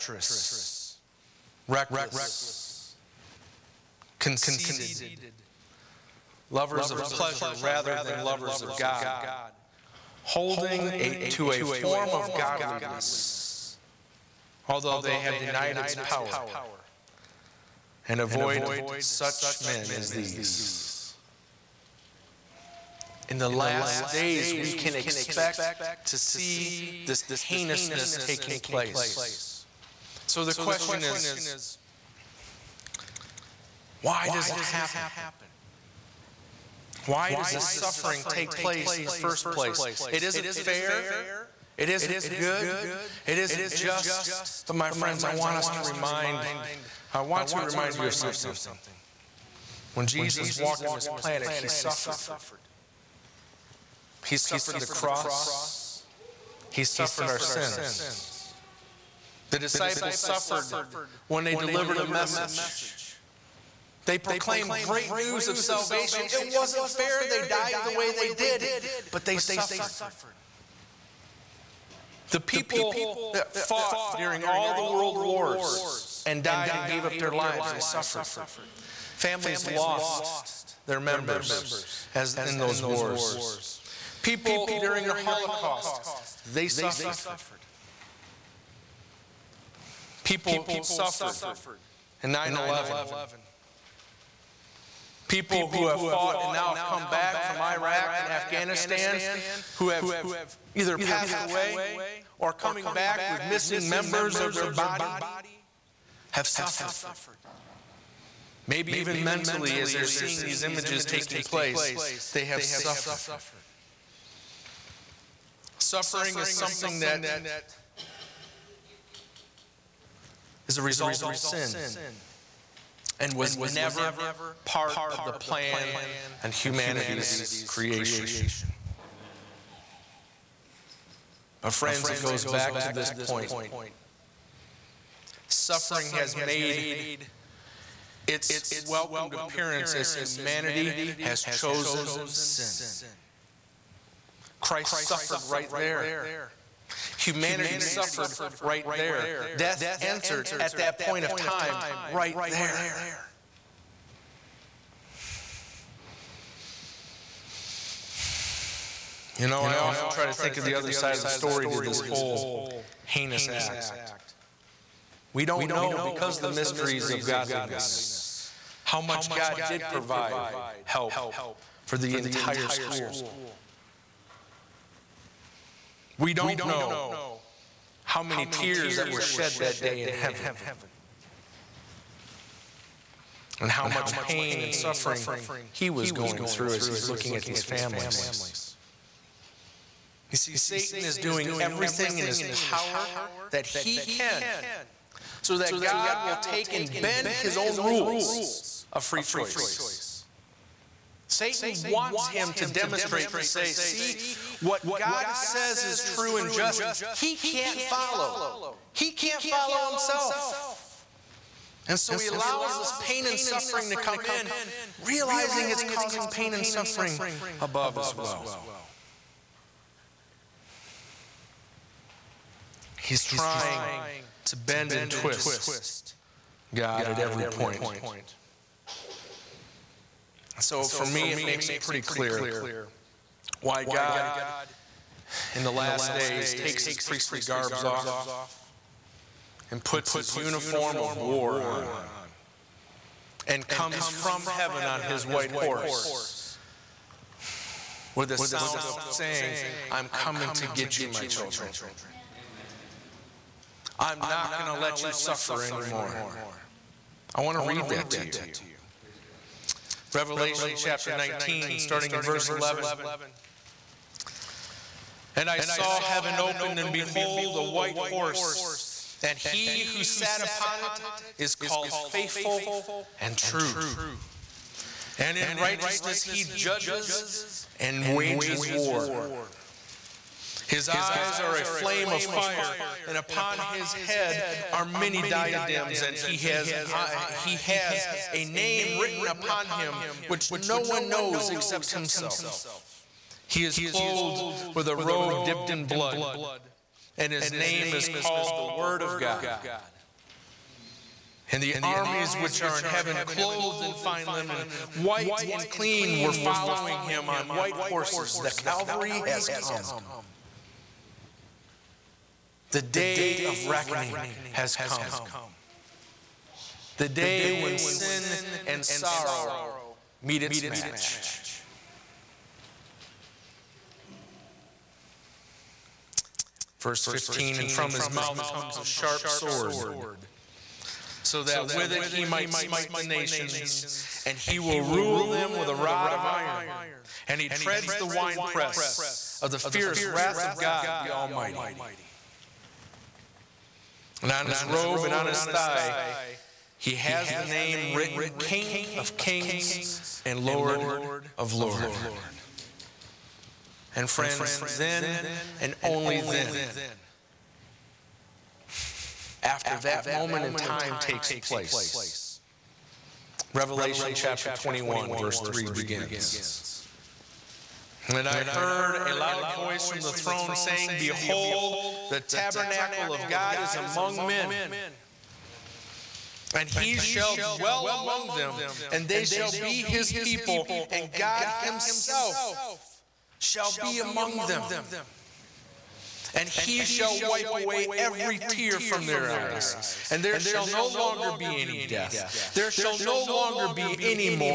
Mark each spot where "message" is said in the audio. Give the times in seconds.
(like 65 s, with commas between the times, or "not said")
62 s.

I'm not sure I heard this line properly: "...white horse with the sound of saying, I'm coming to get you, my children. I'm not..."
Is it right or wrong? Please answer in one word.
right.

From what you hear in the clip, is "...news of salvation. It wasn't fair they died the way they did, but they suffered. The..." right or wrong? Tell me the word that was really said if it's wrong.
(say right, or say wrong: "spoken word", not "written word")
right.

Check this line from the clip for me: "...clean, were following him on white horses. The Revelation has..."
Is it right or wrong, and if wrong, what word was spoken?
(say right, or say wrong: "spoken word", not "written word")
wrong: "Calvary", not "Revelation".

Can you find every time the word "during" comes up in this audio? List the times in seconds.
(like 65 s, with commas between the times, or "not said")
74 s, 84 s.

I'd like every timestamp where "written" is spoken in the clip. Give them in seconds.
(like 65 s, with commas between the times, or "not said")
288 s, 347 s.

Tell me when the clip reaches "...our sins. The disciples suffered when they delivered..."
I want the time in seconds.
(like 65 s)
57 s.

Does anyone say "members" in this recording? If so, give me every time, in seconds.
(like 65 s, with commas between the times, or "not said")
81 s, 103 s.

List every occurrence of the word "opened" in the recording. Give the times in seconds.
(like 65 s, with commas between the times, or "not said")
266 s.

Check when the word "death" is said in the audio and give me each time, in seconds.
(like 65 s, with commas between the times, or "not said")
149 s, 391 s.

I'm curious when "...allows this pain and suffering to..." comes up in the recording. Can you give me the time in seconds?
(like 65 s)
212 s.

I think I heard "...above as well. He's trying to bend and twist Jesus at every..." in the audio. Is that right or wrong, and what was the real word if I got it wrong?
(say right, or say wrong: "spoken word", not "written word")
wrong: "God", not "Jesus".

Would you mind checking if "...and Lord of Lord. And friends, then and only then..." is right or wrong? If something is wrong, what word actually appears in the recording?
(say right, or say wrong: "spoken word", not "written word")
right.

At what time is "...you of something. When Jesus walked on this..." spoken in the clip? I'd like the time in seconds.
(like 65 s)
47 s.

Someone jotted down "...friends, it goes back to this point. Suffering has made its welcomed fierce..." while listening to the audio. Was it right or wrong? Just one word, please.
wrong.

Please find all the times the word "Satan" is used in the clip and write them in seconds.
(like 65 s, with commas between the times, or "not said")
190 s, 201 s.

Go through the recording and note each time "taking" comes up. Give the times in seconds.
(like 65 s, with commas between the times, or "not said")
28 s, 111 s.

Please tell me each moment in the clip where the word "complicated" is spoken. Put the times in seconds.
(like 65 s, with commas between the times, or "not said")
not said.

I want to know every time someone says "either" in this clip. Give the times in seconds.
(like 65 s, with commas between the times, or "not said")
100 s.